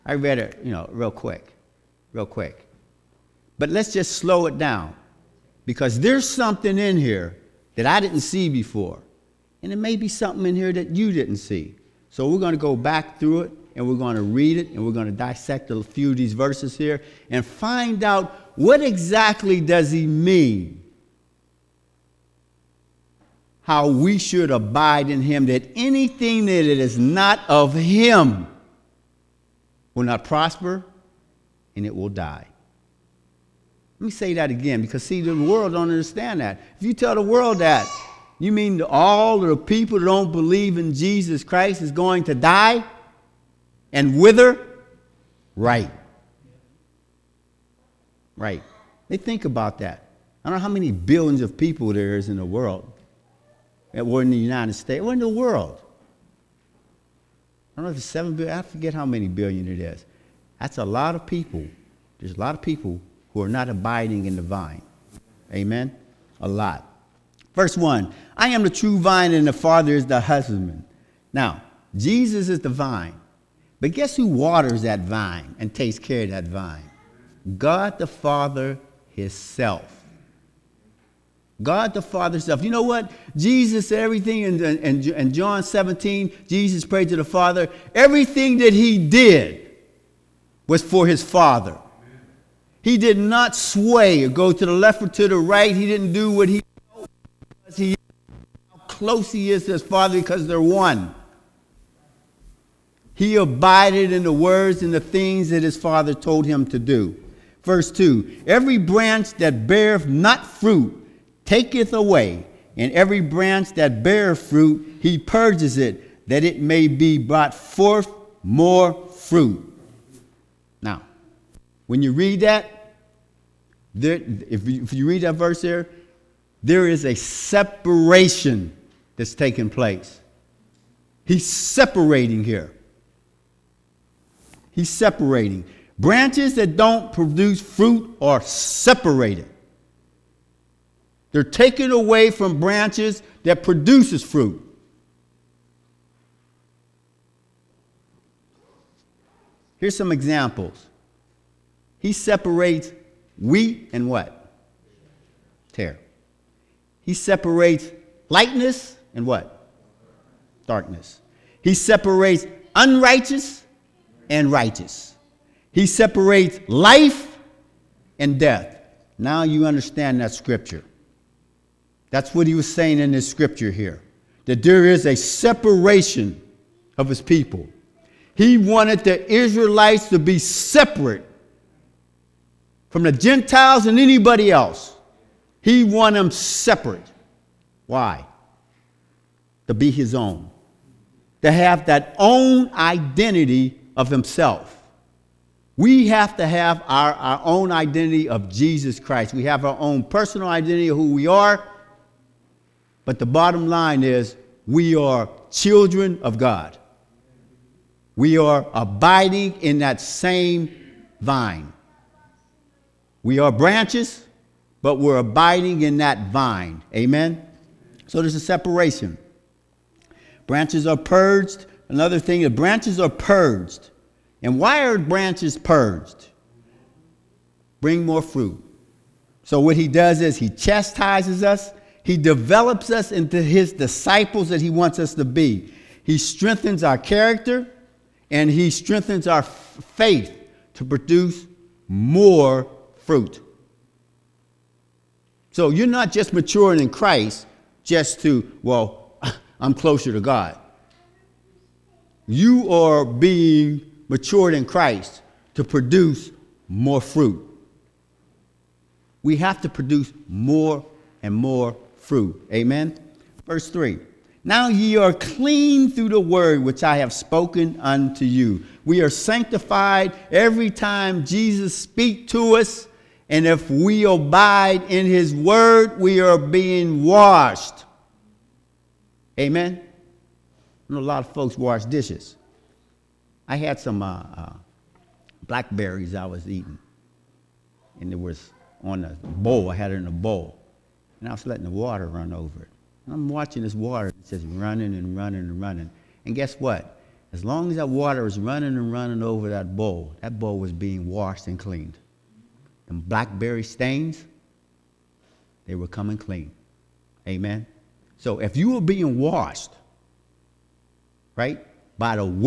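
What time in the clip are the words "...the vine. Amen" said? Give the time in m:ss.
1:04.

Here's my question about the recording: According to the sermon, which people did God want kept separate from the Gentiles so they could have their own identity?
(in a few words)
The Israelites.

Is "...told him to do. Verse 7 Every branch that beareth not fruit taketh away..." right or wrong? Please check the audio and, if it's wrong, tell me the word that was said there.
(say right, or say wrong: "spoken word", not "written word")
wrong: "2", not "7".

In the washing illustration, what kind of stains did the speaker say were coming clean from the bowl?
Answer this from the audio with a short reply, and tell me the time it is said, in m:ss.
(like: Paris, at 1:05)
Blackberry stains, at 5:03.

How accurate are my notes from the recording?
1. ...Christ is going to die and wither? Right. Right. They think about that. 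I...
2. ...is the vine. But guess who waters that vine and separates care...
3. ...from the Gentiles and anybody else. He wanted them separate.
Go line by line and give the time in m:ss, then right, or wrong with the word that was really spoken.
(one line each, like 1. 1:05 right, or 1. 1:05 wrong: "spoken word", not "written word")
1. 0:41 right
2. 1:12 wrong: "takes", not "separates"
3. 3:02 right.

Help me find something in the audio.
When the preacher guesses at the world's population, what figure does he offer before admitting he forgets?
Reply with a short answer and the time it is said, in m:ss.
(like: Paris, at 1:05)
7 billion, at 0:58.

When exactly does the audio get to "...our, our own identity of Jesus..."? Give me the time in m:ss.
3:16.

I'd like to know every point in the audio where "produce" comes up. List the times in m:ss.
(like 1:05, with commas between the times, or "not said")
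2:17, 2:23, 4:00, 4:15, 4:19.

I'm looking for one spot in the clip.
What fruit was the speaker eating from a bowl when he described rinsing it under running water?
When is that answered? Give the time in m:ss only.
4:45.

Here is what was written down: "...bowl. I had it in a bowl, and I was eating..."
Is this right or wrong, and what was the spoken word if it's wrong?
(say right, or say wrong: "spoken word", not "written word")
wrong: "letting", not "eating".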